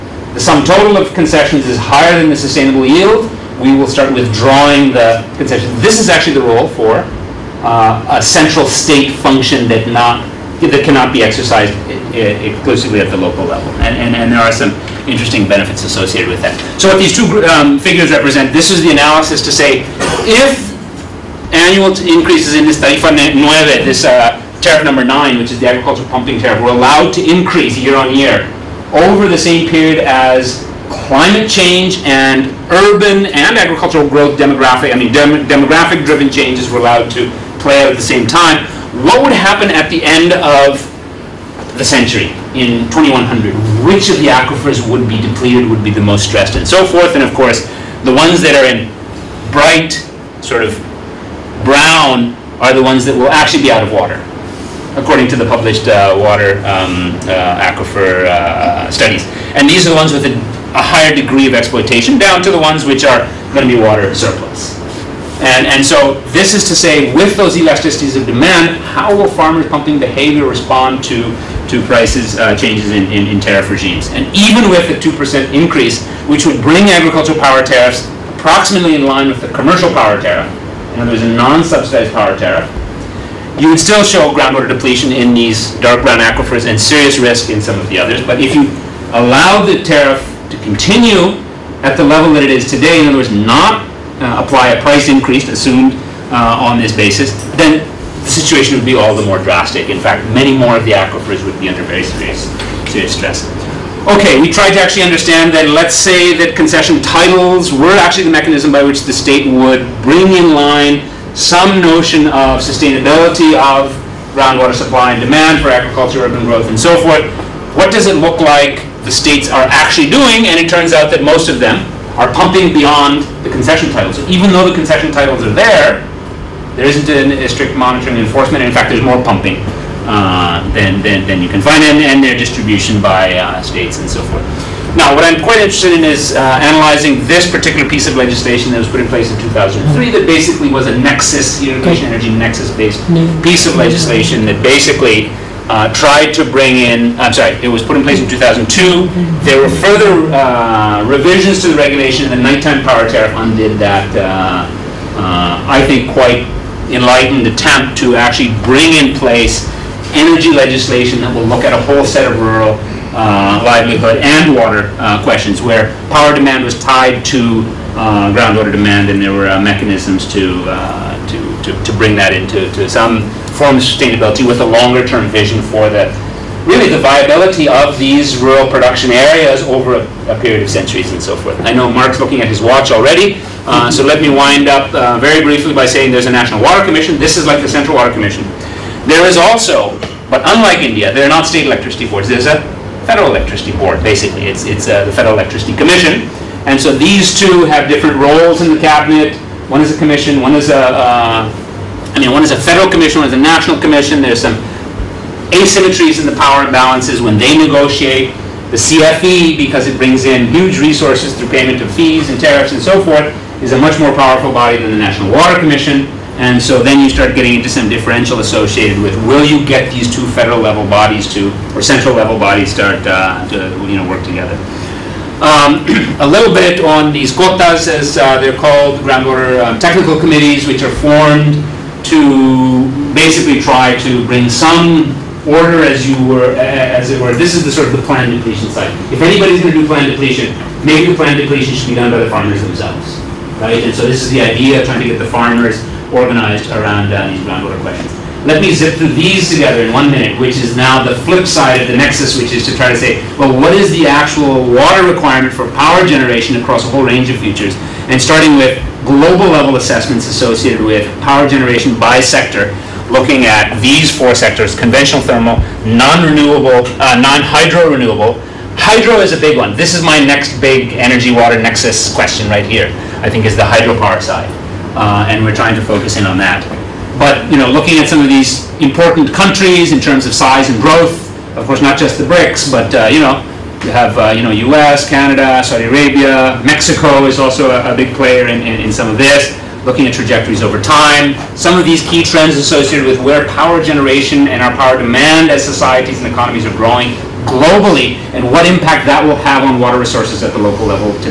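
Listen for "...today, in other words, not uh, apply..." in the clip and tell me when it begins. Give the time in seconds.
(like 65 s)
92 s.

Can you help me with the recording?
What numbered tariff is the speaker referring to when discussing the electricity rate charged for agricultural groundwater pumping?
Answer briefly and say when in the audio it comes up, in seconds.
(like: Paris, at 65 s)
tariff number nine, at 24 s.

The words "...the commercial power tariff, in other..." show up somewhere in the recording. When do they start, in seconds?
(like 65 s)
79 s.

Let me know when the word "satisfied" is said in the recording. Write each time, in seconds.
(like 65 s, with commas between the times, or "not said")
not said.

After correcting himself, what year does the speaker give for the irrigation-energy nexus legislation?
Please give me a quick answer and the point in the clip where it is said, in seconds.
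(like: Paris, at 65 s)
2002, at 148 s.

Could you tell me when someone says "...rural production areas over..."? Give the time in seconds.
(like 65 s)
178 s.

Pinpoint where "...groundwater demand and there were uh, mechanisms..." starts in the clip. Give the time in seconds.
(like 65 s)
168 s.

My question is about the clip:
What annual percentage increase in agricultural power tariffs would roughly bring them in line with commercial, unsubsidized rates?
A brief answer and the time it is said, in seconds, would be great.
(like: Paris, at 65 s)
2%, at 75 s.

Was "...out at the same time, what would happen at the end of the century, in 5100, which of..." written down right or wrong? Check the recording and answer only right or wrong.
wrong.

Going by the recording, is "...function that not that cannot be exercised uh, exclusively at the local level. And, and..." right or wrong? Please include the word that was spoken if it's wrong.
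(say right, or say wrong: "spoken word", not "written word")
right.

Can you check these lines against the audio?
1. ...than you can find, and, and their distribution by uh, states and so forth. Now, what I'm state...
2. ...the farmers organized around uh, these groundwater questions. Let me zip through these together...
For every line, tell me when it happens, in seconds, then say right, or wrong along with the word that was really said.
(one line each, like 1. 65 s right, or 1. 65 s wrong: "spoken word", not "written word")
1. 131 s wrong: "quite", not "state"
2. 245 s right.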